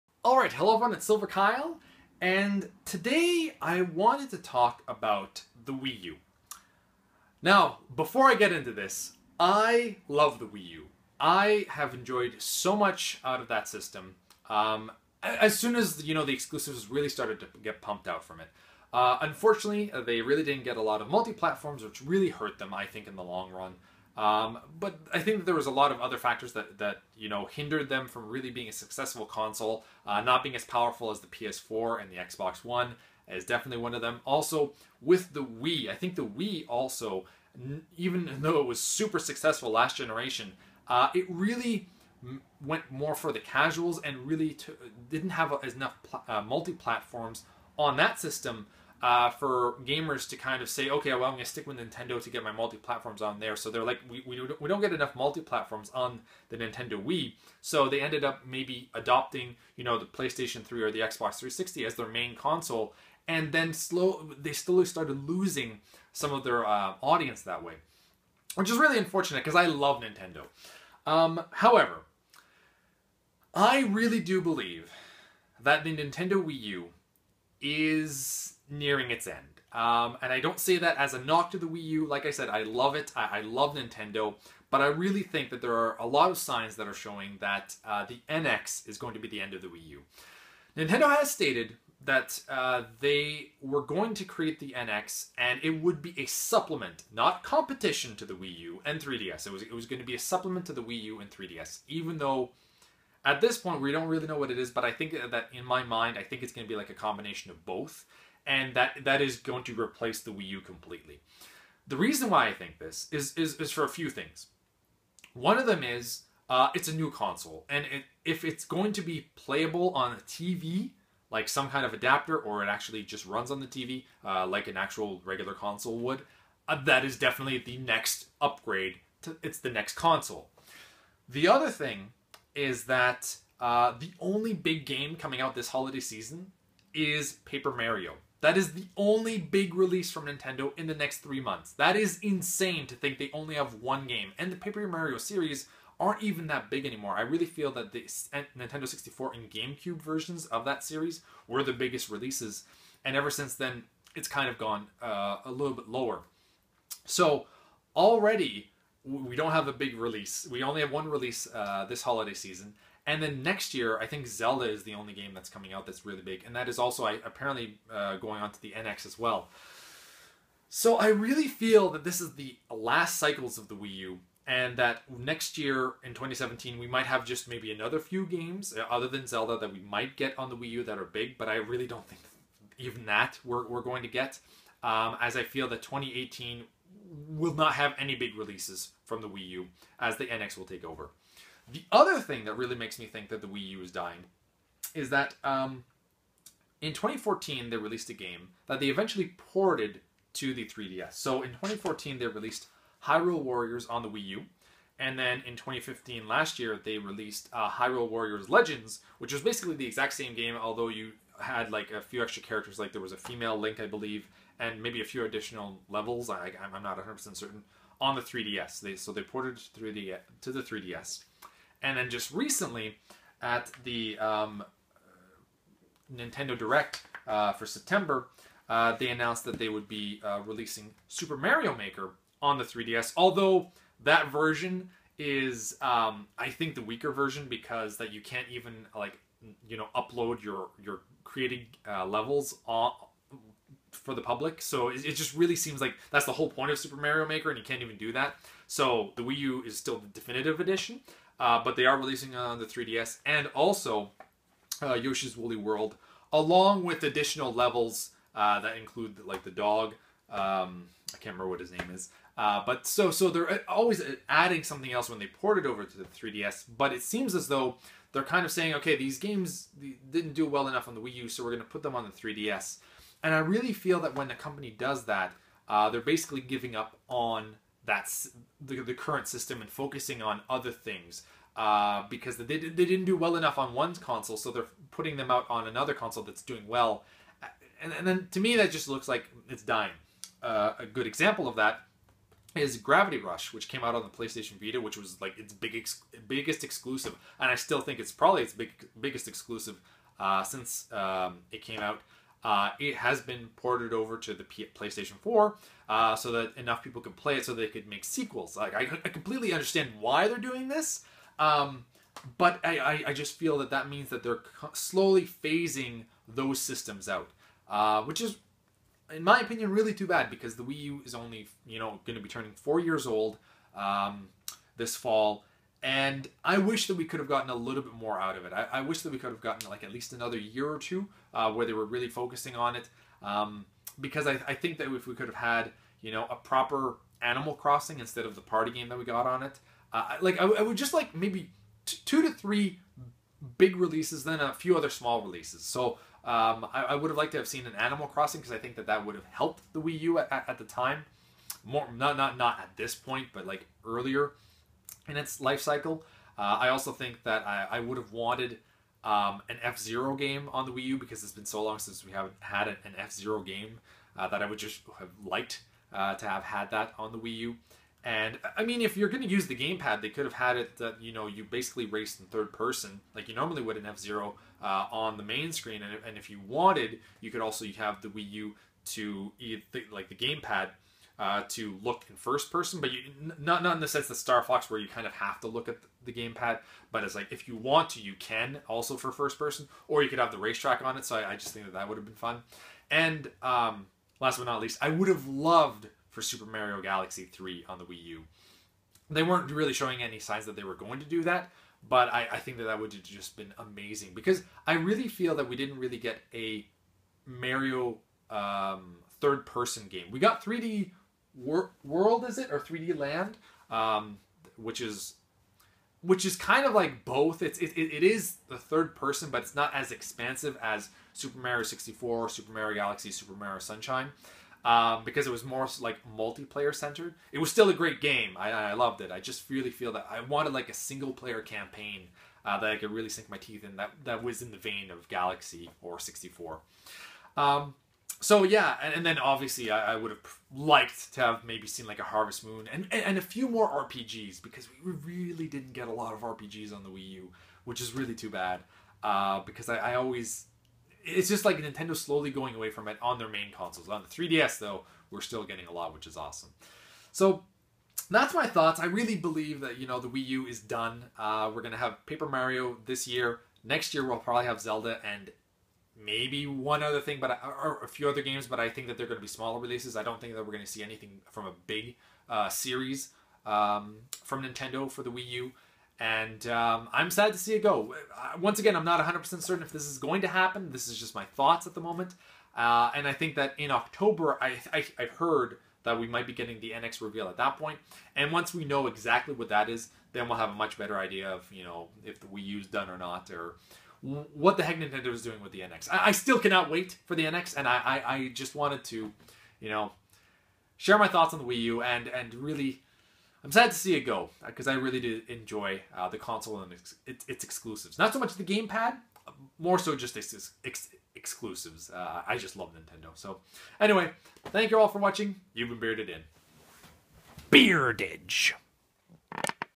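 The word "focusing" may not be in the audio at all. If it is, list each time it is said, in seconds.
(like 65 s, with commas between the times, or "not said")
279 s, 332 s.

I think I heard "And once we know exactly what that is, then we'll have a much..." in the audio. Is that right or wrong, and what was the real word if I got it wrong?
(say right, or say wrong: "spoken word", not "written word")
right.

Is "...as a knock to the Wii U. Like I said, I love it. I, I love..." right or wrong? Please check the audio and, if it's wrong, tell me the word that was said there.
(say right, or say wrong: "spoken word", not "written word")
right.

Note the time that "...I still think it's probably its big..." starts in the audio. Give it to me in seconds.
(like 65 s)
297 s.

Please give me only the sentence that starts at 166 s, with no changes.
And that is also I, apparently uh, going on to the NX as well.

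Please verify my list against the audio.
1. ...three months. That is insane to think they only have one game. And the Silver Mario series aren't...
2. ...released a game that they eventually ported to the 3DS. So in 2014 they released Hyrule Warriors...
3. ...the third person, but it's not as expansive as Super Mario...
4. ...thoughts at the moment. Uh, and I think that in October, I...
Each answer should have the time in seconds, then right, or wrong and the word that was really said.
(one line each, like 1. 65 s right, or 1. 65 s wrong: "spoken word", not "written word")
1. 141 s wrong: "Paper", not "Silver"
2. 197 s right
3. 418 s right
4. 481 s right.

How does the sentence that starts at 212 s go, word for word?
Like there was a female Link, I believe, and maybe a few additional levels.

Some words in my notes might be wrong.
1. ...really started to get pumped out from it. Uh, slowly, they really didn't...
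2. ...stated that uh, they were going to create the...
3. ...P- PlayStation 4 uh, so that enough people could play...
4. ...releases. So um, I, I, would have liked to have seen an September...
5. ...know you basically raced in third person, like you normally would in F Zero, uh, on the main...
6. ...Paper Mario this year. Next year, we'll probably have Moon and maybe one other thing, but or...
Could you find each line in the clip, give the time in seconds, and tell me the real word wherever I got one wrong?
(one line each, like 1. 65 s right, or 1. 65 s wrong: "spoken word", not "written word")
1. 16 s wrong: "unfortunately", not "slowly"
2. 91 s right
3. 304 s right
4. 345 s wrong: "Animal", not "September"
5. 371 s right
6. 462 s wrong: "Zelda", not "Moon".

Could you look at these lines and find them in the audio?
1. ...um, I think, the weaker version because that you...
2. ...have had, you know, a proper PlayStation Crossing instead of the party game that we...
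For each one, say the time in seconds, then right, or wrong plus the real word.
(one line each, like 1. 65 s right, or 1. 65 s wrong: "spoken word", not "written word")
1. 235 s right
2. 335 s wrong: "Animal", not "PlayStation".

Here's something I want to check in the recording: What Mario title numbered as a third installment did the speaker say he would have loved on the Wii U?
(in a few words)
Super Mario Galaxy 3.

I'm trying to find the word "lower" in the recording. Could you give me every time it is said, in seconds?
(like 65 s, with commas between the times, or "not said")
155 s.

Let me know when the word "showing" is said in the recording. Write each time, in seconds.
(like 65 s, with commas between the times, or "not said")
86 s, 399 s.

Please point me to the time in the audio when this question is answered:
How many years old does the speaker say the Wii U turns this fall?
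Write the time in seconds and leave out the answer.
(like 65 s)
322 s.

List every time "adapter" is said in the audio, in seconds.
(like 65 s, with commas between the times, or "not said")
121 s.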